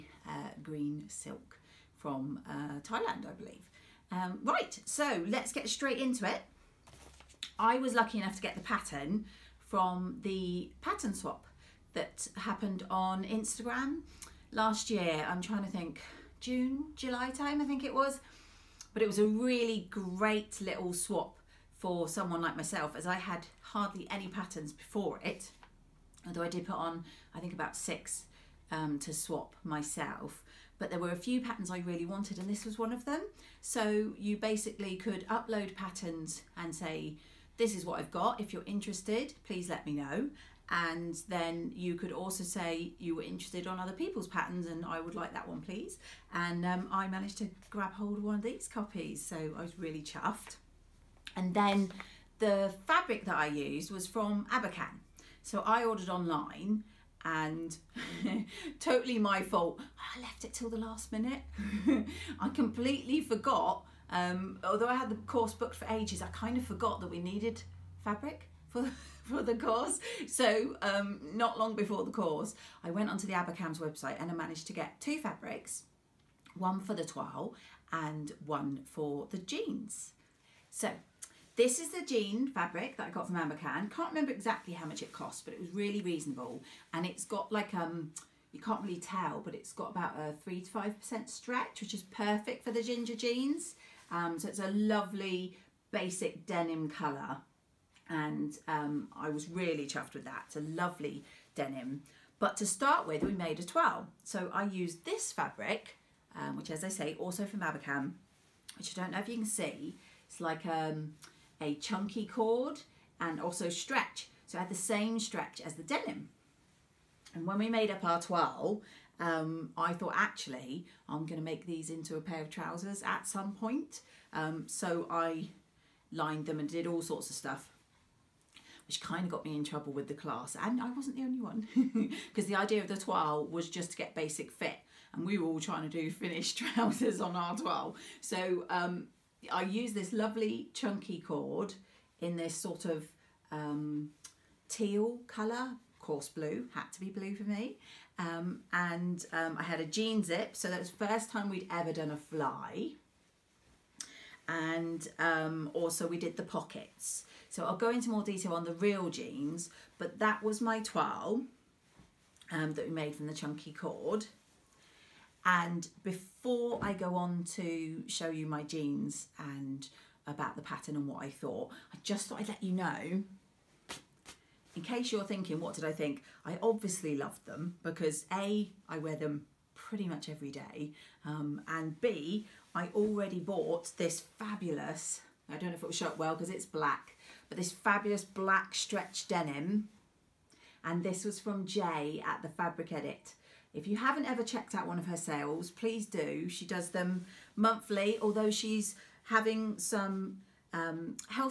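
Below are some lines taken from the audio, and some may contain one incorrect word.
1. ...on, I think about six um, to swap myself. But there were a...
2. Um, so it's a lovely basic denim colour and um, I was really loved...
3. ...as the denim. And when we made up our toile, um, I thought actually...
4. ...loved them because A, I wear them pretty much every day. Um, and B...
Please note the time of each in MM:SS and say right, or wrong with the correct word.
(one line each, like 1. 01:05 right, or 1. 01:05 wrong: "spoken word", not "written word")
1. 00:26 right
2. 01:34 wrong: "chuffed", not "loved"
3. 01:55 right
4. 02:57 right.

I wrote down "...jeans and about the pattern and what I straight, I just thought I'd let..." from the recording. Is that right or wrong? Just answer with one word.
wrong.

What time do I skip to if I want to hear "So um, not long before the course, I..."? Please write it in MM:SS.
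01:10.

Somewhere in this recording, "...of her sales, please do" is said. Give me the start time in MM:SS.
03:14.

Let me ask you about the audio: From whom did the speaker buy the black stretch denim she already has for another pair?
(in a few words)
Jay at the Fabric Edit.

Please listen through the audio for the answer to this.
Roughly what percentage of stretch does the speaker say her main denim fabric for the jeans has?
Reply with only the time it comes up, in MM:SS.
01:30.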